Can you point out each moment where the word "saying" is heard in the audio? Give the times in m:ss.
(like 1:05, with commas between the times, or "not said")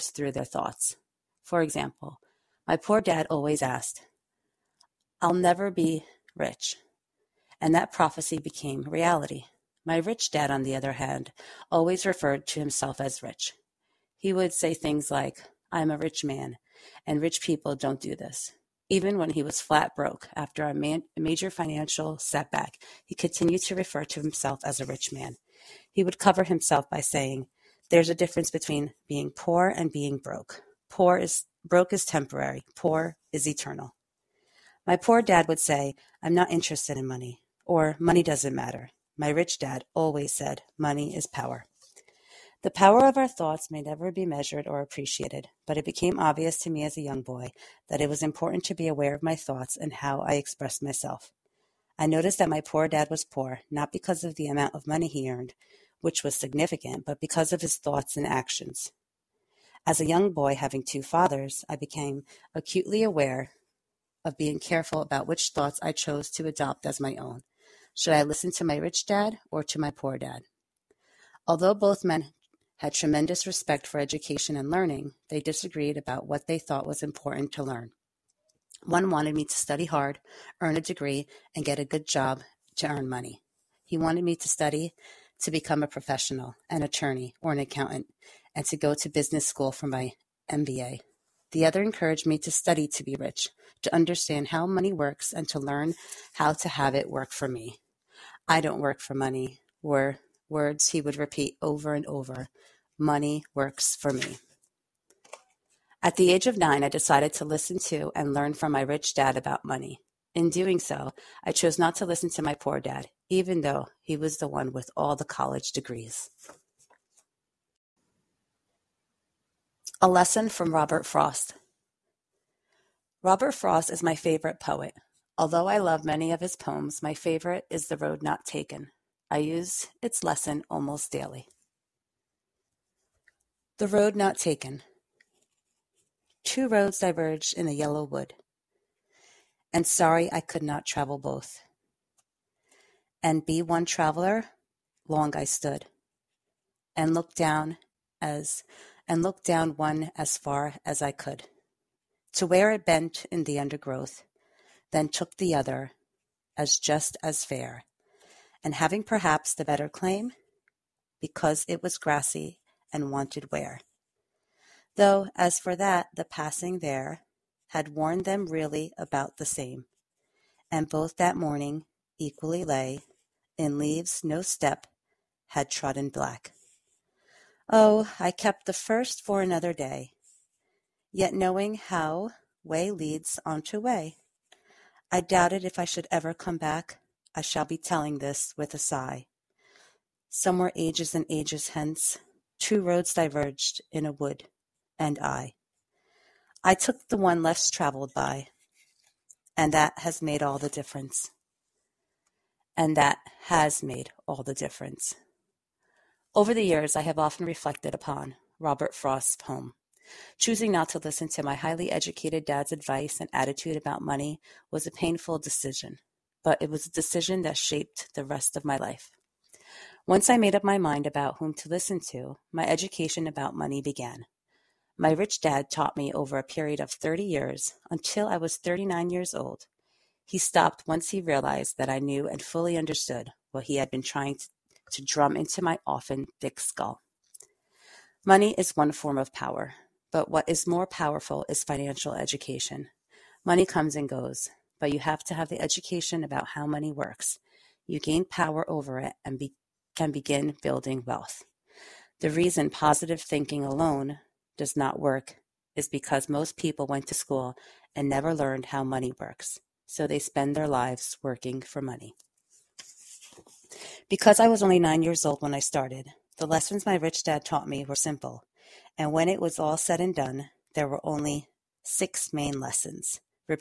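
0:26.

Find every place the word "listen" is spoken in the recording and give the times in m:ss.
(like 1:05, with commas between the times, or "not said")
1:08, 1:47, 1:52, 3:30, 3:41.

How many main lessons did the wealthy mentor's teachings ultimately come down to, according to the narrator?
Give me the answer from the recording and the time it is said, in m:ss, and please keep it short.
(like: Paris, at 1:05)
6, at 4:31.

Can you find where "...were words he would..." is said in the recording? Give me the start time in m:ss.
1:39.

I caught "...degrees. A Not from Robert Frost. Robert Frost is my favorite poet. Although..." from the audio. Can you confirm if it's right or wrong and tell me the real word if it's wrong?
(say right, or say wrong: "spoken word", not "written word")
wrong: "Lesson", not "Not".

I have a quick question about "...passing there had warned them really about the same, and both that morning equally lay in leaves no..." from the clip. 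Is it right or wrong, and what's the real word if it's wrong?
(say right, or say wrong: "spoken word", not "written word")
right.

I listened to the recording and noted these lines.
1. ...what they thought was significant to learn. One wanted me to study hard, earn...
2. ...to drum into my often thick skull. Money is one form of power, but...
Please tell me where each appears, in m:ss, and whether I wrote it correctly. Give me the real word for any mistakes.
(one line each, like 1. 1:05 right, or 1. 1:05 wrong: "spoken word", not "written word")
1. 1:16 wrong: "important", not "significant"
2. 3:54 right.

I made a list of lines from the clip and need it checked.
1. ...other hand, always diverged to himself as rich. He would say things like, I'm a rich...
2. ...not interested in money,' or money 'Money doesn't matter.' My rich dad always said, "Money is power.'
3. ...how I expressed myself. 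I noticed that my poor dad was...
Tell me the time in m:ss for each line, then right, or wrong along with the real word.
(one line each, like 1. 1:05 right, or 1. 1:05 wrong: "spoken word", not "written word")
1. 0:10 wrong: "referred", not "diverged"
2. 0:36 right
3. 0:49 right.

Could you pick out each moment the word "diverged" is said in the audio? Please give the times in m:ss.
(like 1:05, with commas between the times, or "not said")
2:16, 3:13.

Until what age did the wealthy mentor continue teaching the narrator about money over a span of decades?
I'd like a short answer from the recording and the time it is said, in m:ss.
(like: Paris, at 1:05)
39, at 3:48.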